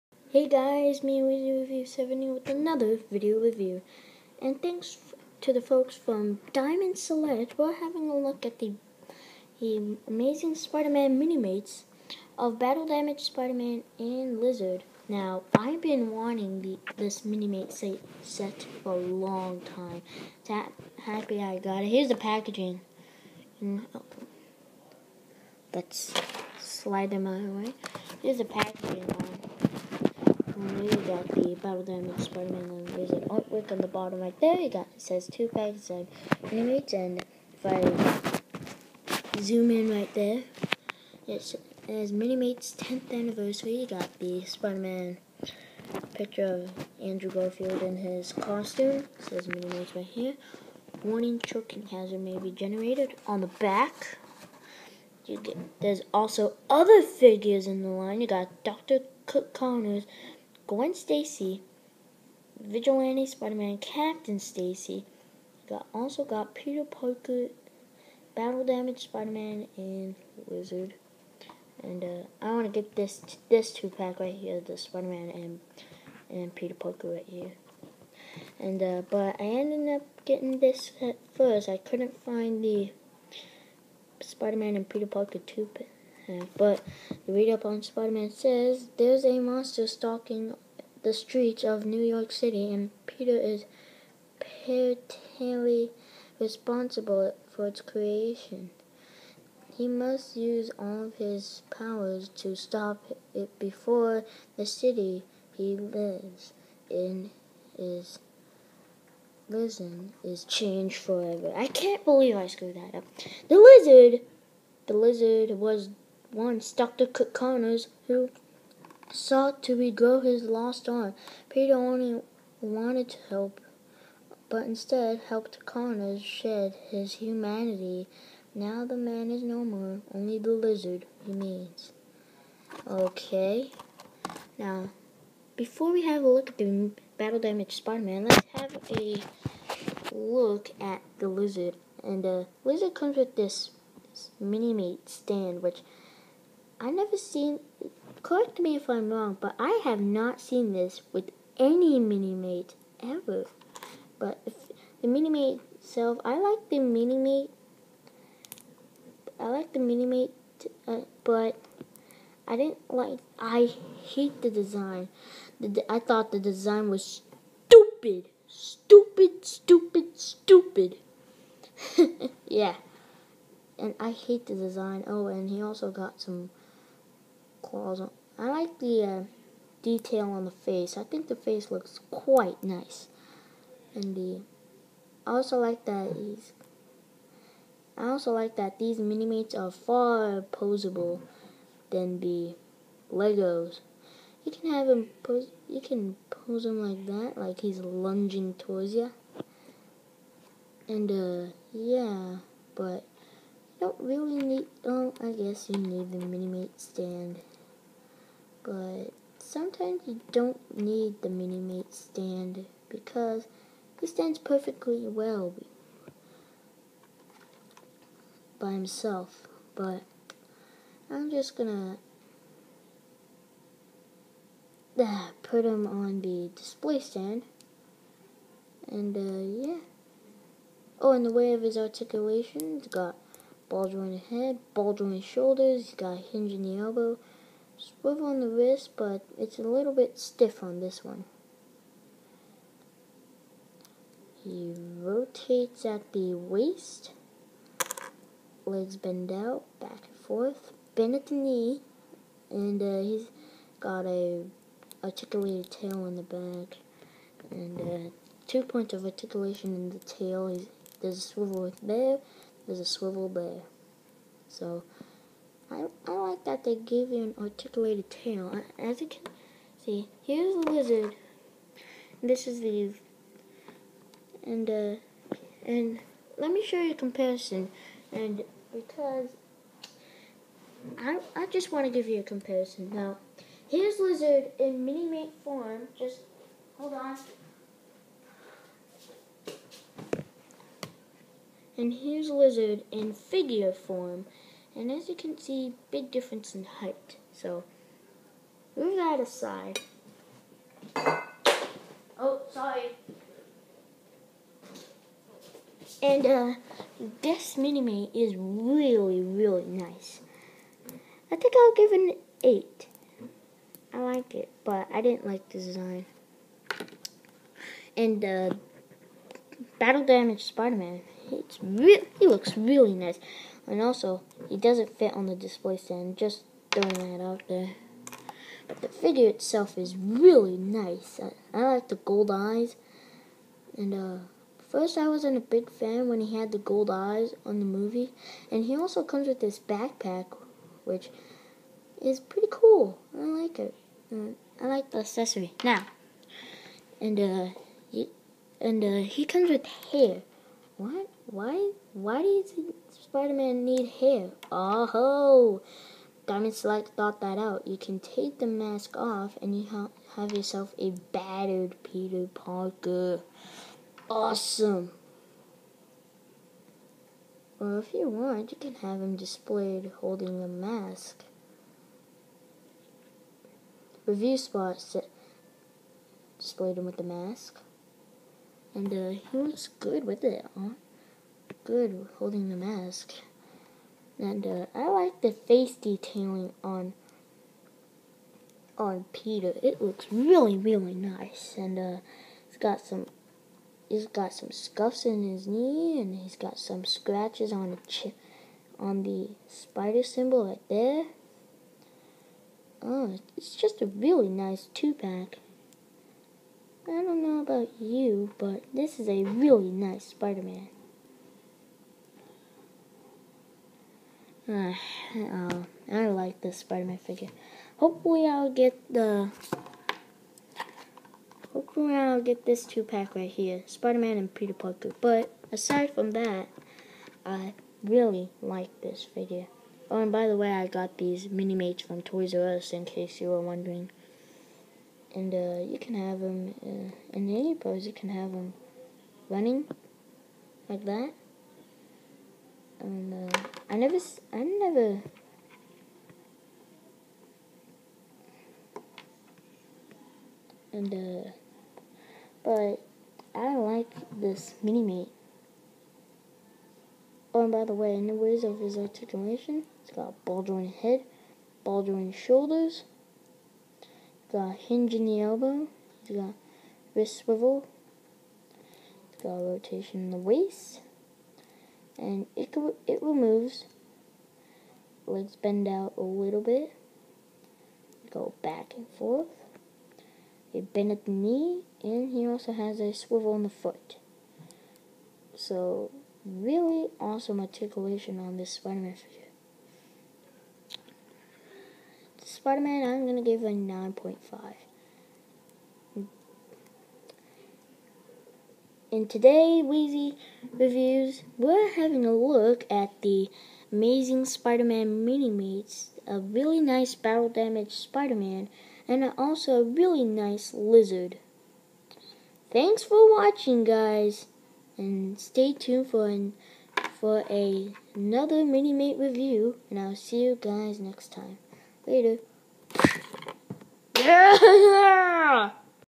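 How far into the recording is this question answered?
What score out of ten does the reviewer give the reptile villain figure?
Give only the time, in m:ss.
5:12.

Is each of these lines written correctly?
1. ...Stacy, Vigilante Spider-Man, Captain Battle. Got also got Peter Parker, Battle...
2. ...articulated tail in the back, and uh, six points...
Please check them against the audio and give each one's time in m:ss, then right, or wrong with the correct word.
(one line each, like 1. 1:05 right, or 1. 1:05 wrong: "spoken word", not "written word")
1. 1:00 wrong: "Stacy", not "Battle"
2. 4:15 wrong: "two", not "six".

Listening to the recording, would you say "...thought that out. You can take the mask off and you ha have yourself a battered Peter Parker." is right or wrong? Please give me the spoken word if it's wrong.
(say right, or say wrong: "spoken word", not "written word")
right.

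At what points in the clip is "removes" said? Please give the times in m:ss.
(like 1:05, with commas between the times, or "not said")
7:53.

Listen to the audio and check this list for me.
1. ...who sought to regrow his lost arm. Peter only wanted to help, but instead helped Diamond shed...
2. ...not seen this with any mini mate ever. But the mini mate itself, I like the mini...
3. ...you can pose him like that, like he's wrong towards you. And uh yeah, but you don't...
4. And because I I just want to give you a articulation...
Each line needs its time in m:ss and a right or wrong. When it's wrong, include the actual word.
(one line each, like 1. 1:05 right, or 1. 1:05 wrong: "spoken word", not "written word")
1. 1:58 wrong: "Connors", not "Diamond"
2. 2:30 right
3. 3:15 wrong: "lunging", not "wrong"
4. 4:38 wrong: "comparison", not "articulation".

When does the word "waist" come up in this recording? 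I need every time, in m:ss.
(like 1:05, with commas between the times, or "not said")
4:06, 7:50.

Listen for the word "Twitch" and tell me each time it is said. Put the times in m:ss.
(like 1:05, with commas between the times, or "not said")
not said.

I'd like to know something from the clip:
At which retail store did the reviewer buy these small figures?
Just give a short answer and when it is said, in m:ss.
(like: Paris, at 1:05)
Toys R Us, at 7:12.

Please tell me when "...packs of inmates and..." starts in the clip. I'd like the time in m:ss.
0:35.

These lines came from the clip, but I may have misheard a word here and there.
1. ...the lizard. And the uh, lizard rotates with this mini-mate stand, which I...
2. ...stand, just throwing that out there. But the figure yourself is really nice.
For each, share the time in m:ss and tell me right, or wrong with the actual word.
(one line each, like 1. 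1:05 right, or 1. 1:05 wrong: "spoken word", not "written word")
1. 2:21 wrong: "comes", not "rotates"
2. 5:25 wrong: "itself", not "yourself".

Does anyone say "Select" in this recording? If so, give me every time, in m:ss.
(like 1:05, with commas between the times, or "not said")
0:06, 5:56.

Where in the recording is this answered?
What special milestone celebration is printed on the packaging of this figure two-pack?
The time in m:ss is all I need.
0:42.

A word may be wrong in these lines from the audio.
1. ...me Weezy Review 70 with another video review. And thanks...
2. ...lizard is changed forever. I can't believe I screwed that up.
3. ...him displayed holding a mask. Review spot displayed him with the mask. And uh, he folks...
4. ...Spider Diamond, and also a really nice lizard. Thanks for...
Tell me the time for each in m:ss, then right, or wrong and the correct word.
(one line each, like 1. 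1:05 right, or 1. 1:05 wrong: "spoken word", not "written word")
1. 0:01 right
2. 1:49 right
3. 6:09 wrong: "looks", not "folks"
4. 8:27 wrong: "Man", not "Diamond".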